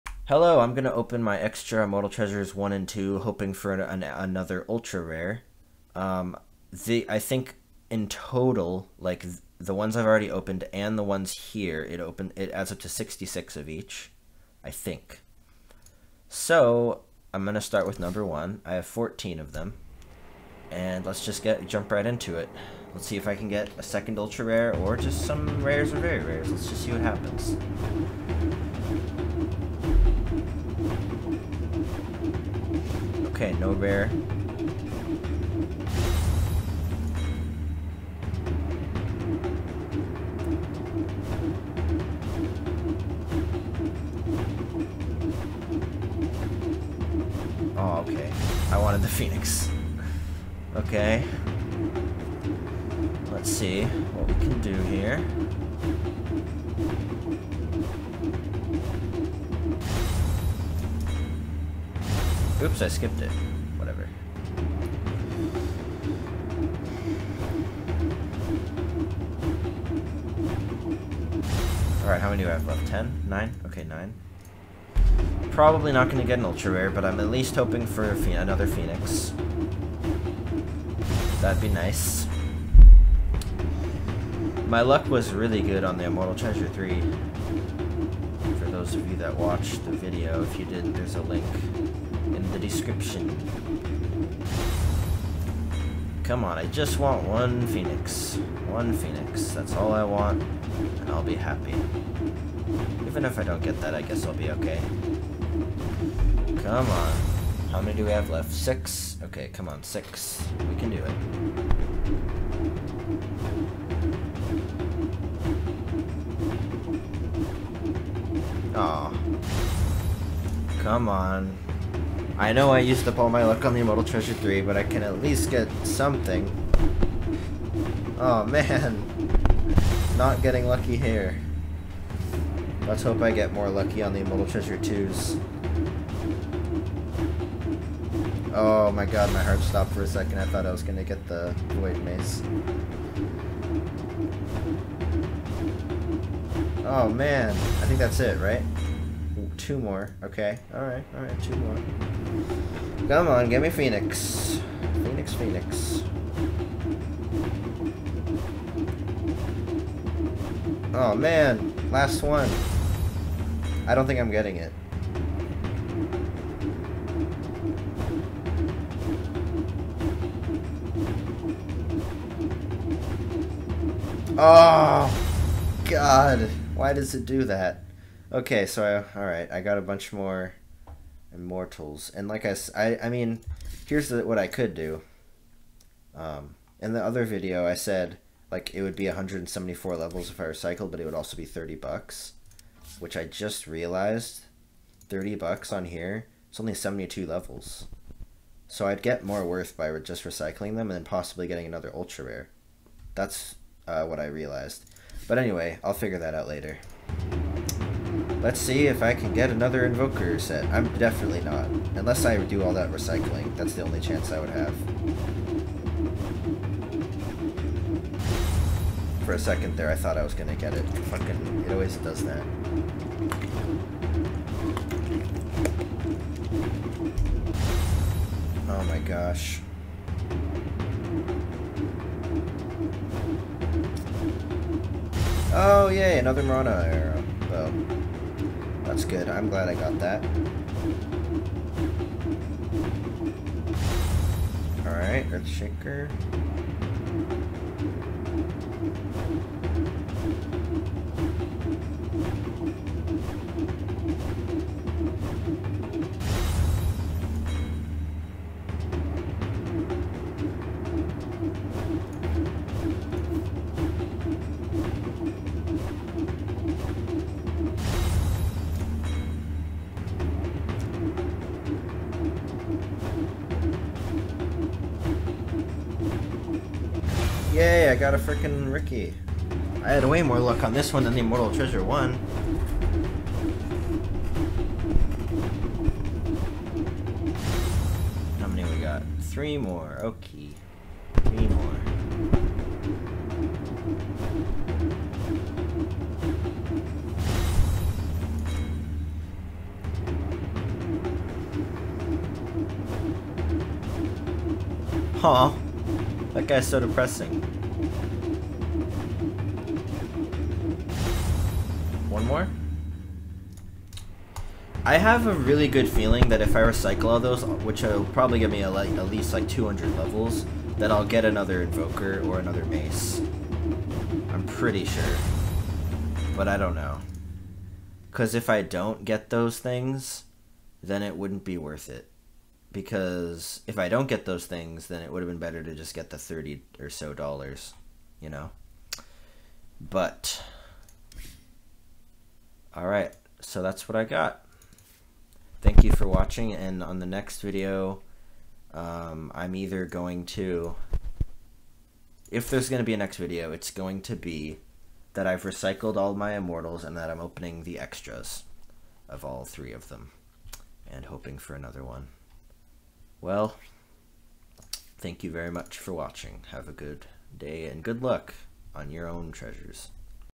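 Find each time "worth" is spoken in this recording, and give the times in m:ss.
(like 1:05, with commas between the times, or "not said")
3:19, 5:31.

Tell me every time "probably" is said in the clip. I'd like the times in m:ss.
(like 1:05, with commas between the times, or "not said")
1:15, 5:18.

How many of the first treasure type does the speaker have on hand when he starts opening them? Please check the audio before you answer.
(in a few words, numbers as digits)
14.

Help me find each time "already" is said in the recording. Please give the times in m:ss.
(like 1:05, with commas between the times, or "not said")
0:10.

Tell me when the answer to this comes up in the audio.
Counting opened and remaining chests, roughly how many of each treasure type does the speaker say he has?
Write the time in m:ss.
0:12.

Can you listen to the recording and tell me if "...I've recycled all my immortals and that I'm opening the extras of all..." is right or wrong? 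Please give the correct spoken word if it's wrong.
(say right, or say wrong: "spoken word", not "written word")
right.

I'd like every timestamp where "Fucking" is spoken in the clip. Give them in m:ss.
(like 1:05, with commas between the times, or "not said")
3:40.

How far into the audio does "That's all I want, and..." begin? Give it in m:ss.
1:39.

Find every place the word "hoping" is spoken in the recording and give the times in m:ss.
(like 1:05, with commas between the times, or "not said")
0:03, 1:17, 6:01.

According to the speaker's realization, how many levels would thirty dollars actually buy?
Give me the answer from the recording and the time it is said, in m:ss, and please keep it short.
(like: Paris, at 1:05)
72, at 3:16.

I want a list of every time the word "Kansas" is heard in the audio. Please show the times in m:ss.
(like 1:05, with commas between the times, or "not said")
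not said.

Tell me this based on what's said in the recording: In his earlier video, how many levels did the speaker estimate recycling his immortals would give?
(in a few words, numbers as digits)
174.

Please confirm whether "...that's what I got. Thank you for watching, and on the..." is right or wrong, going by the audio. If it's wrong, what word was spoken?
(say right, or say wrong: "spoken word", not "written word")
right.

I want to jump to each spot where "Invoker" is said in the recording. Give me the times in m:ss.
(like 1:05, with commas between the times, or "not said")
3:29, 5:21.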